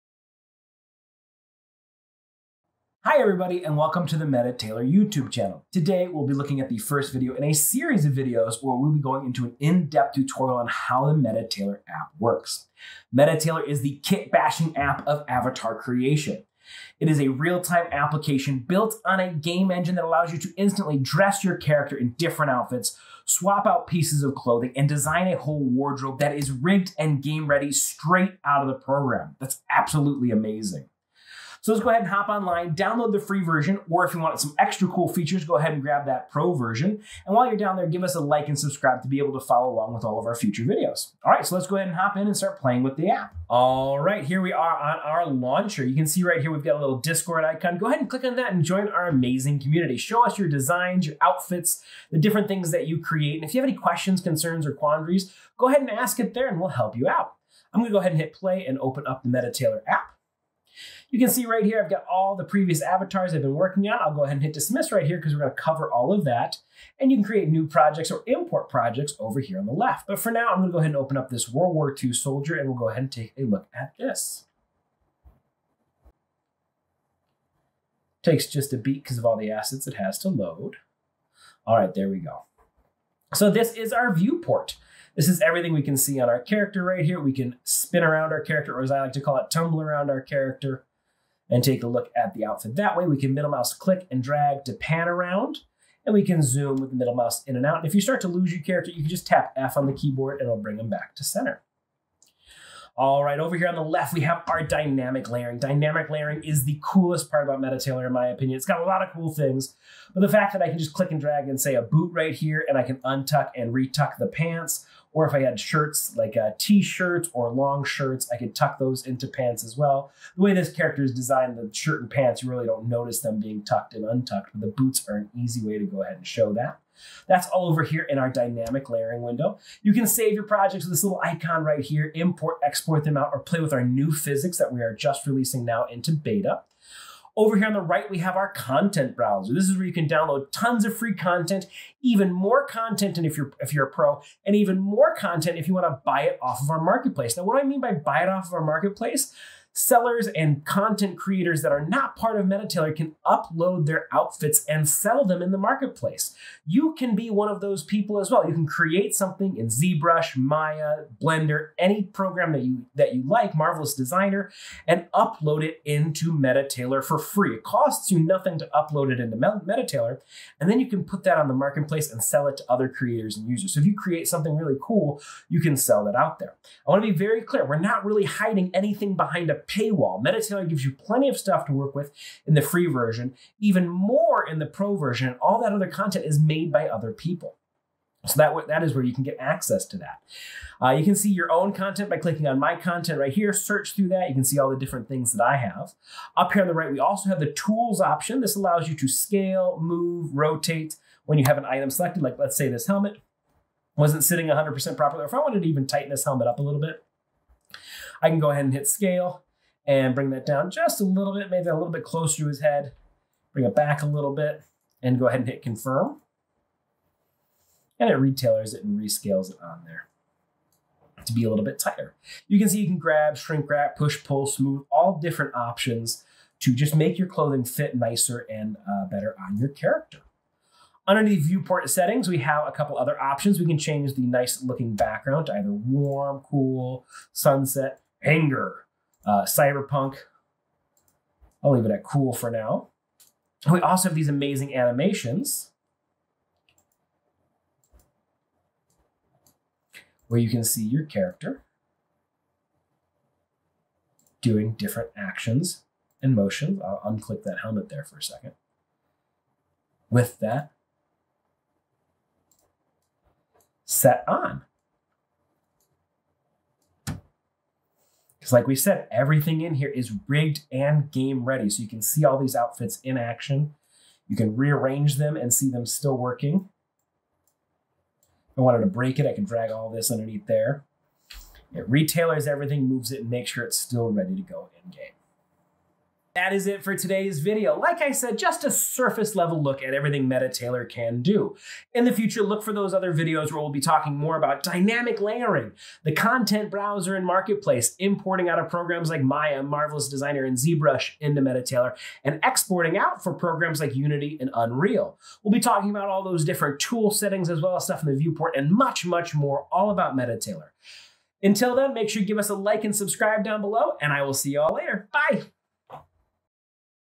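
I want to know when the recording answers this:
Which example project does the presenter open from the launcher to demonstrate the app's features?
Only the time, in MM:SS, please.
01:11.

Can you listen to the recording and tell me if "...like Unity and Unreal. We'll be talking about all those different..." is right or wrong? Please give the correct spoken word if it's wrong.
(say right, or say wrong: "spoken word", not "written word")
right.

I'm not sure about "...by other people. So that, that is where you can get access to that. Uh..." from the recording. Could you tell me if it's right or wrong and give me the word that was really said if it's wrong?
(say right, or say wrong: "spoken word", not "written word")
right.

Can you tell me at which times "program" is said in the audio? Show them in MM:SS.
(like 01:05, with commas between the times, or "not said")
00:28, 02:42, 04:58, 05:03.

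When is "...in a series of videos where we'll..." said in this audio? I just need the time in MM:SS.
00:07.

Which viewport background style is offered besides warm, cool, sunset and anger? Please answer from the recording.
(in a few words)
Cyberpunk.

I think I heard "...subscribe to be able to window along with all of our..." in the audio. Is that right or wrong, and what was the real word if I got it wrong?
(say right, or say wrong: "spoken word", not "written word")
wrong: "follow", not "window".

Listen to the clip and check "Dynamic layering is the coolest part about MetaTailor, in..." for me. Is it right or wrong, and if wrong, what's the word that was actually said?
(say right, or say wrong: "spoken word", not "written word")
right.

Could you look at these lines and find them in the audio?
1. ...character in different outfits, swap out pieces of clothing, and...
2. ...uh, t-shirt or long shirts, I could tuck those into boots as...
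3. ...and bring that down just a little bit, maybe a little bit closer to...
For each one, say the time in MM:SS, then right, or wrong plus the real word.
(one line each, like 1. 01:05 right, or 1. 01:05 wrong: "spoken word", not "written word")
1. 00:21 right
2. 01:56 wrong: "pants", not "boots"
3. 03:29 right.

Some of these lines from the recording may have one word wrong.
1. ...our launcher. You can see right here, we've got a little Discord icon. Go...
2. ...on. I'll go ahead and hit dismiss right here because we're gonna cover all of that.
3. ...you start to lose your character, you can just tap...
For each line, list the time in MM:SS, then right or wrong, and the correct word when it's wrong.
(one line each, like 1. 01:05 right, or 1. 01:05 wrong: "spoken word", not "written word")
1. 00:45 right
2. 01:03 right
3. 01:37 right.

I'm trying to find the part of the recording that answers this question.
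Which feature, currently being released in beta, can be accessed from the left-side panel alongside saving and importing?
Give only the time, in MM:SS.
02:14.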